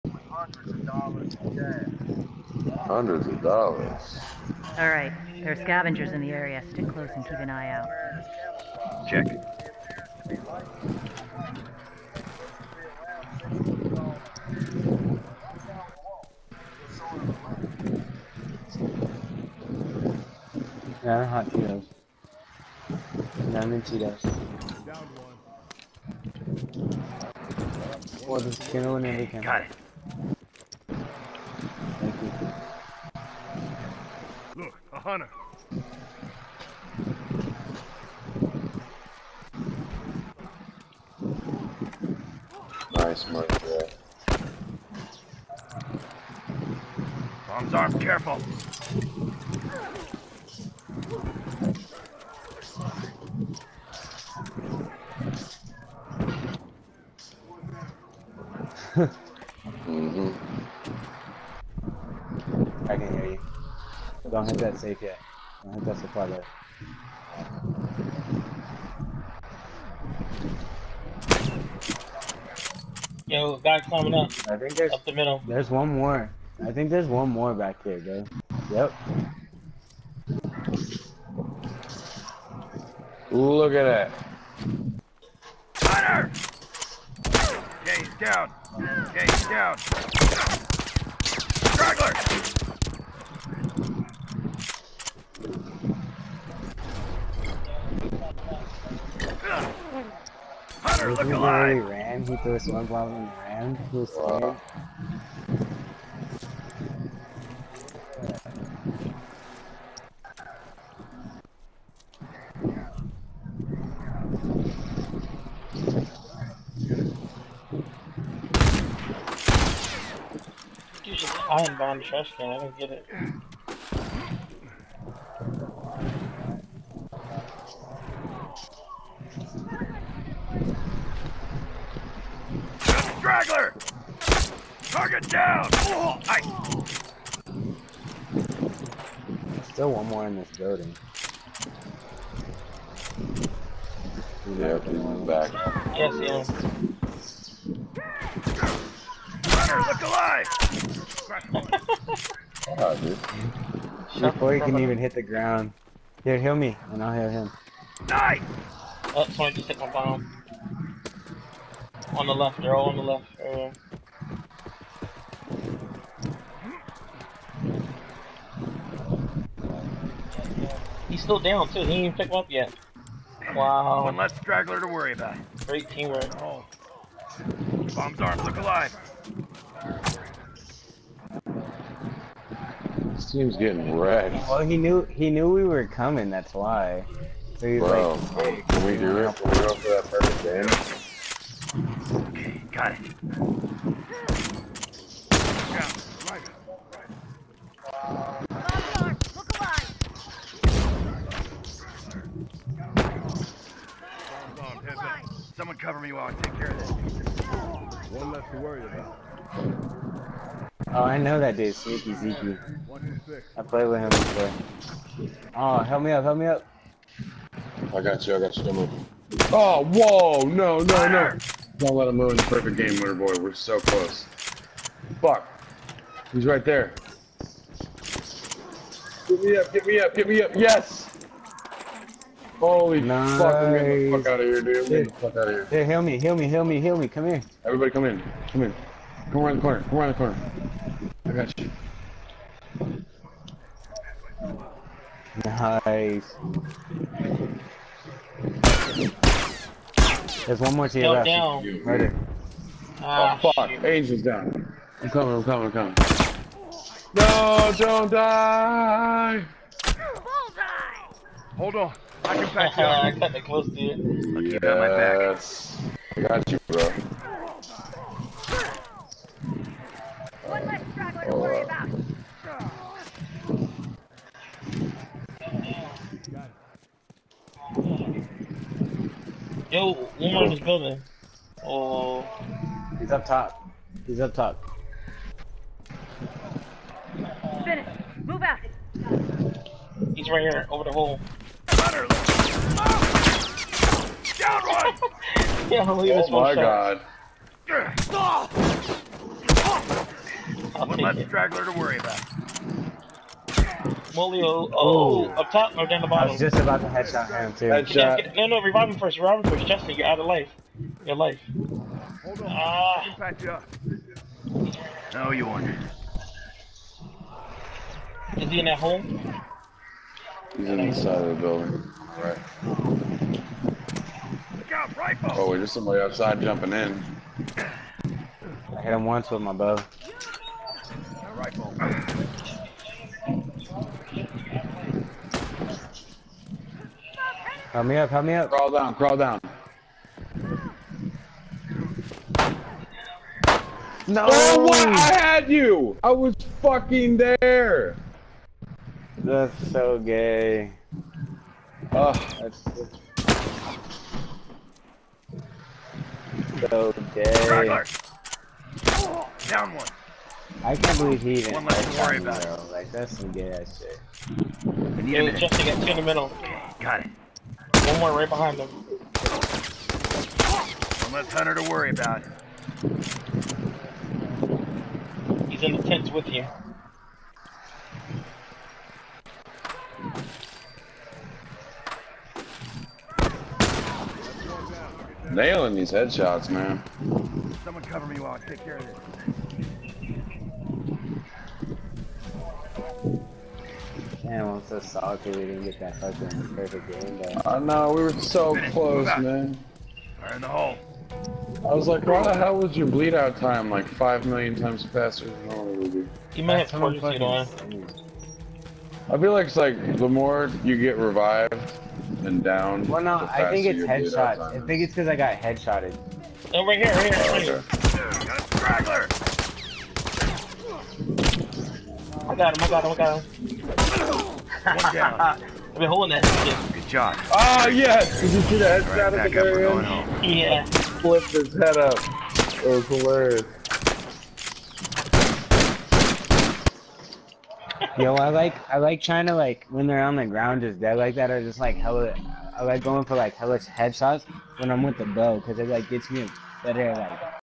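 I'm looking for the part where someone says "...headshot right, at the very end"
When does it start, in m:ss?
7:08.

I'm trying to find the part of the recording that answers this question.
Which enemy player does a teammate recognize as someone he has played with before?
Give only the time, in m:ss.
3:31.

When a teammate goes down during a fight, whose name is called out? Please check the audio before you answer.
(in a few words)
Angel.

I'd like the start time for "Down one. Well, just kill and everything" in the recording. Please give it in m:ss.
0:24.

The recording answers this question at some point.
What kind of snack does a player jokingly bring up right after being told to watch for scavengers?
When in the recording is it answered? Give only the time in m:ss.
0:21.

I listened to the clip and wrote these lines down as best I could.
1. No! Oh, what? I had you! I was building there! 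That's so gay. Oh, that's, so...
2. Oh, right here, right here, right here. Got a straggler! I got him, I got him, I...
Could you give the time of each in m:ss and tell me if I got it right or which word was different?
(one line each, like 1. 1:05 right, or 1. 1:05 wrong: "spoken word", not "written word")
1. 5:44 wrong: "fucking", not "building"
2. 6:56 right.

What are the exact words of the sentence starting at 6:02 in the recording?
Like that's some gay ass shit.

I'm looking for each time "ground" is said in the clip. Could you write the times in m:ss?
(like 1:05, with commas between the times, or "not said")
2:35, 7:20.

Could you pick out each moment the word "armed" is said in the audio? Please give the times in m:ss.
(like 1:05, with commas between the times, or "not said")
2:58.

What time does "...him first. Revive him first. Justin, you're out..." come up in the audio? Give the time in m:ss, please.
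5:08.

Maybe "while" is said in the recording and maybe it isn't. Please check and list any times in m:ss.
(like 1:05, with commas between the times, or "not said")
3:26, 6:28.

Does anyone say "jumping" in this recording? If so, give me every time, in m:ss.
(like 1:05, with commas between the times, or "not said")
5:26.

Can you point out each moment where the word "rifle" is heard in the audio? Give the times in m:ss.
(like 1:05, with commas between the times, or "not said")
5:24, 5:31.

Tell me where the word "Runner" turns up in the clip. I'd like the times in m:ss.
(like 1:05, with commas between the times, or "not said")
2:29, 4:51.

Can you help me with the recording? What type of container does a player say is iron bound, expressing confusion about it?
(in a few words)
Trash can.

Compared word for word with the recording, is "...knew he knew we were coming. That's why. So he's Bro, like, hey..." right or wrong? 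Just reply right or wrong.
right.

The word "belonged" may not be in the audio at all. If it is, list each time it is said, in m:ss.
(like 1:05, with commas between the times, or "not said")
not said.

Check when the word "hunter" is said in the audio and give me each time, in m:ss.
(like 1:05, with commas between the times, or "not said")
0:34, 1:25, 1:40, 6:11.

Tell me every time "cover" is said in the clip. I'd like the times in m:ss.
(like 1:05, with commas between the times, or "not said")
3:25, 6:27.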